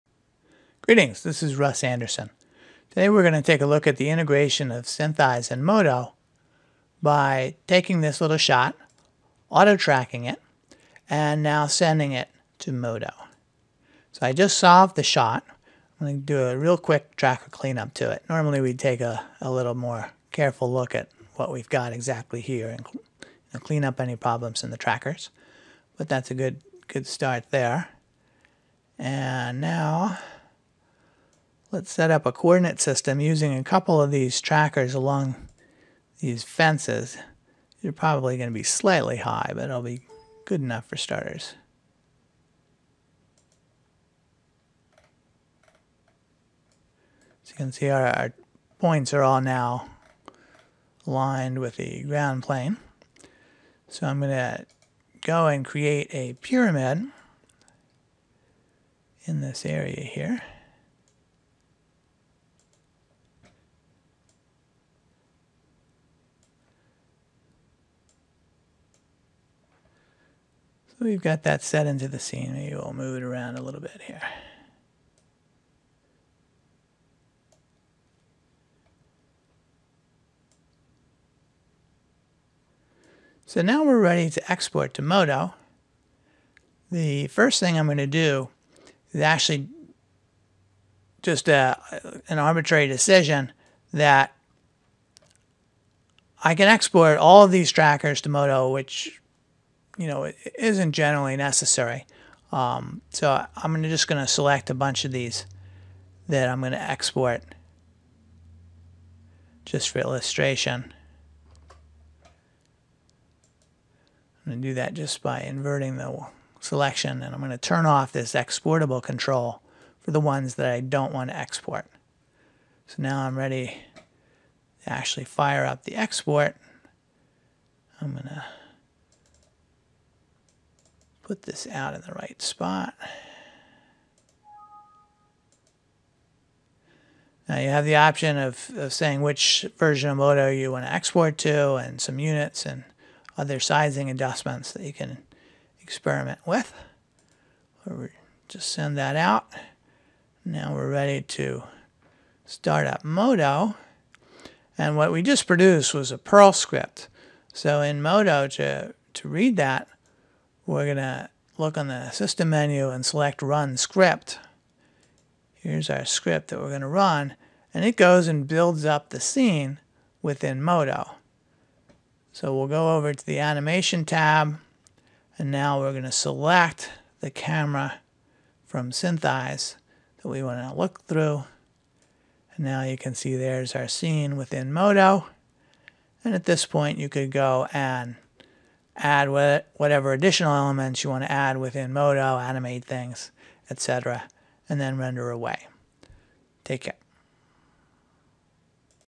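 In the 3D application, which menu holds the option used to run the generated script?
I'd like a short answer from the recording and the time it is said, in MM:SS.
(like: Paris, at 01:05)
System menu, at 02:42.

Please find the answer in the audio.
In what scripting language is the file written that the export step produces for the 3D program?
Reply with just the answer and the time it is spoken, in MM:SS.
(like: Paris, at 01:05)
Perl, at 02:36.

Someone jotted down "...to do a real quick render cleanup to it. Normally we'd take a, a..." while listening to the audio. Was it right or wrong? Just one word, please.
wrong.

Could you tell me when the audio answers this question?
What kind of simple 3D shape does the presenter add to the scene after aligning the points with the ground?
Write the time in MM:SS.
00:56.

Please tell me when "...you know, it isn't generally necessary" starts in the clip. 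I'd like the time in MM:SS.
01:39.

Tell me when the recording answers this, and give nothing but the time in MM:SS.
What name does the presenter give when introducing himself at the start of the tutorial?
00:01.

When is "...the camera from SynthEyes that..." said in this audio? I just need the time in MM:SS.
02:57.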